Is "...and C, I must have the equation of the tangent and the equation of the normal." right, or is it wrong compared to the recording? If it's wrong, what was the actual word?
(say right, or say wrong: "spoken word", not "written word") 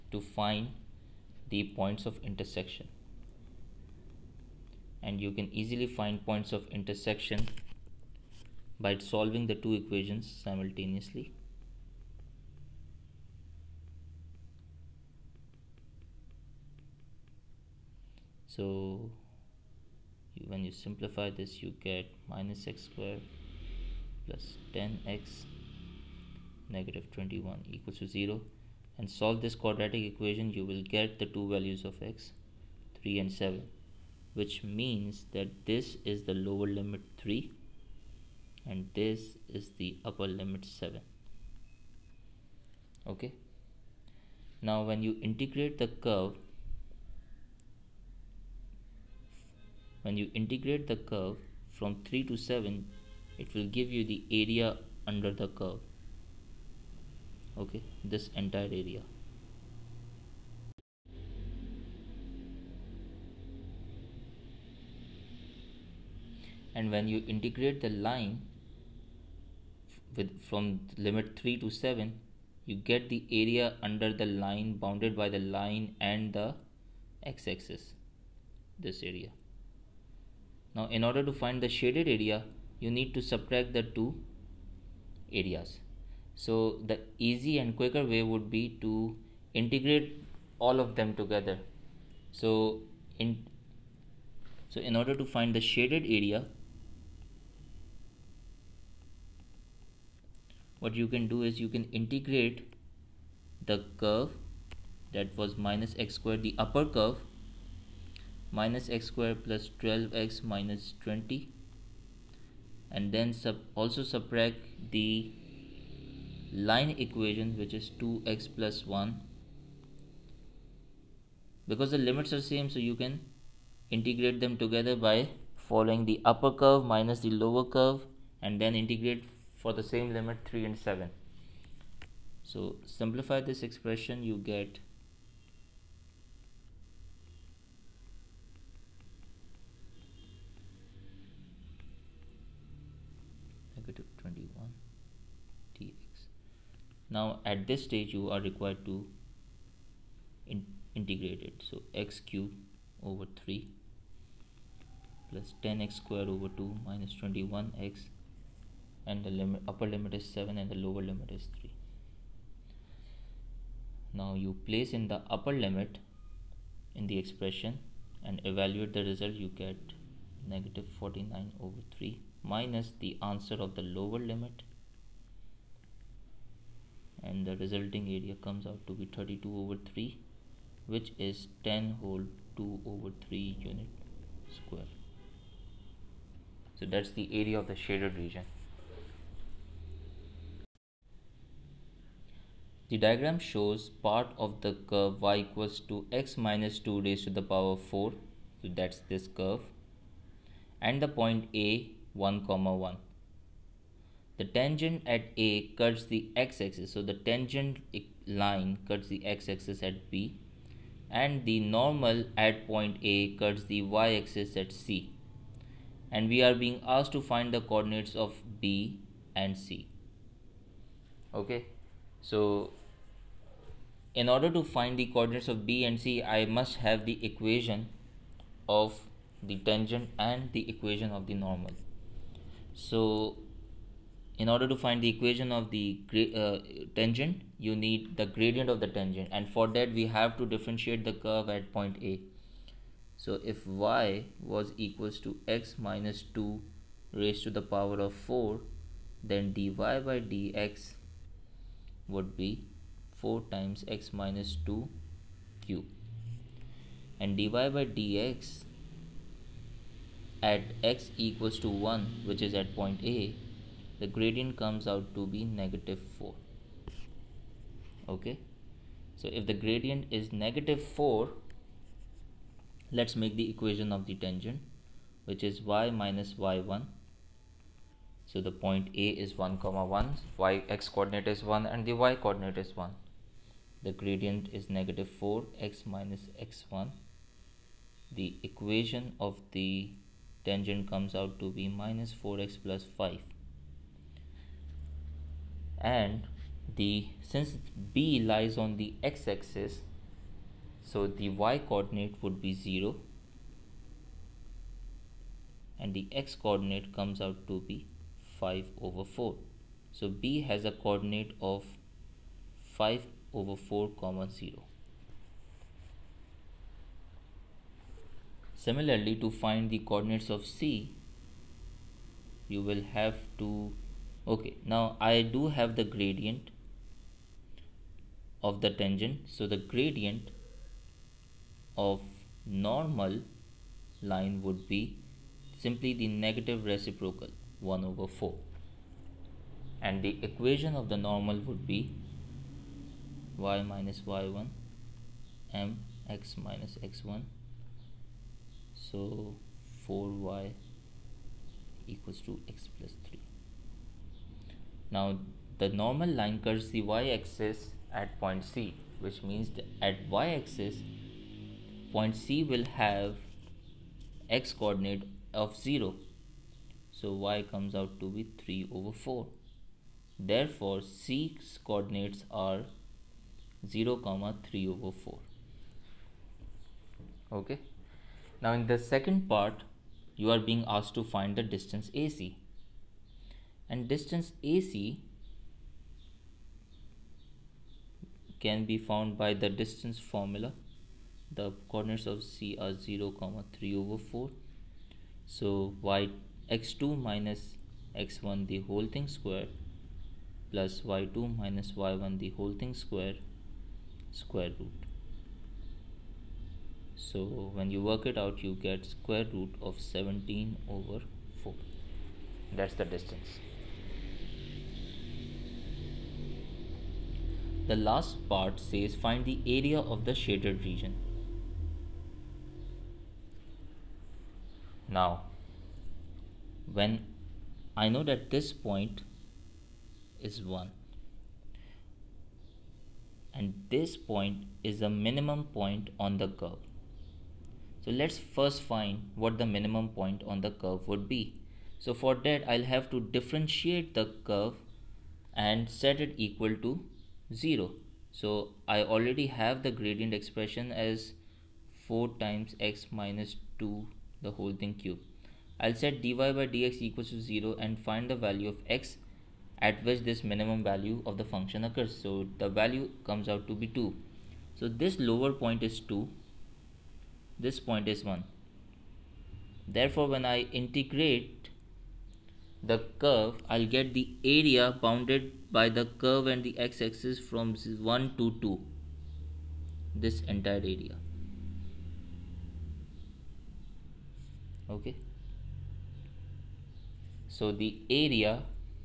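right.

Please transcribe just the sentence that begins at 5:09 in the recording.
So B has a coordinate of 5 over 4 comma 0.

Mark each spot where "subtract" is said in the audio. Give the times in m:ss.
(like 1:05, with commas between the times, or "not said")
1:23, 1:54.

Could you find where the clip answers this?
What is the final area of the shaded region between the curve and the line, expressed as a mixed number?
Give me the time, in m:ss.
3:01.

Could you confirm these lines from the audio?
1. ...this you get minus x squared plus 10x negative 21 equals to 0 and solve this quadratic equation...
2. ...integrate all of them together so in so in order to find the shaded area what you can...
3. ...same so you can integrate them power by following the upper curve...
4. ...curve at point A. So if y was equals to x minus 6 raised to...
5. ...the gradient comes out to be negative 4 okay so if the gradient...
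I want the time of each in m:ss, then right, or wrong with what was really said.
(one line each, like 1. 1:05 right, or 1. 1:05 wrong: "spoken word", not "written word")
1. 0:21 right
2. 1:29 right
3. 2:02 wrong: "together", not "power"
4. 4:01 wrong: "2", not "6"
5. 4:23 right.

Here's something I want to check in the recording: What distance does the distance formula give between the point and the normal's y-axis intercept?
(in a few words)
√17/4.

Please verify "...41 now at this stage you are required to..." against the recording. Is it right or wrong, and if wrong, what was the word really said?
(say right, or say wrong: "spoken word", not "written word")
wrong: "21", not "41".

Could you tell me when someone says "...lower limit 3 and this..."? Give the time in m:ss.
0:36.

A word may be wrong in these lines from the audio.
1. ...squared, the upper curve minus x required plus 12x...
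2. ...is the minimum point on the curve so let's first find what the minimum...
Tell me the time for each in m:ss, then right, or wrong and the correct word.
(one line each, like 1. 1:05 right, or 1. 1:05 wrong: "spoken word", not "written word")
1. 1:46 wrong: "squared", not "required"
2. 7:14 right.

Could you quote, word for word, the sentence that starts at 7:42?
So the value comes out to be 2.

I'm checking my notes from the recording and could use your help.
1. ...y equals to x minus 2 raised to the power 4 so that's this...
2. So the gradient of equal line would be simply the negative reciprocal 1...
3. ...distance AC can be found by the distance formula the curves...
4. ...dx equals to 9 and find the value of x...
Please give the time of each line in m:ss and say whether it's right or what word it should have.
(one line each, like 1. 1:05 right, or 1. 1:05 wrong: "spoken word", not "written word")
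1. 3:15 right
2. 5:29 wrong: "normal", not "equal"
3. 6:23 wrong: "coordinates", not "curves"
4. 7:36 wrong: "0", not "9".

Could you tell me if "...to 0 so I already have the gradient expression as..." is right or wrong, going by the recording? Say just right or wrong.
right.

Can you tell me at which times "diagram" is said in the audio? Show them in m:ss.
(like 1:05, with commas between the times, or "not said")
3:12.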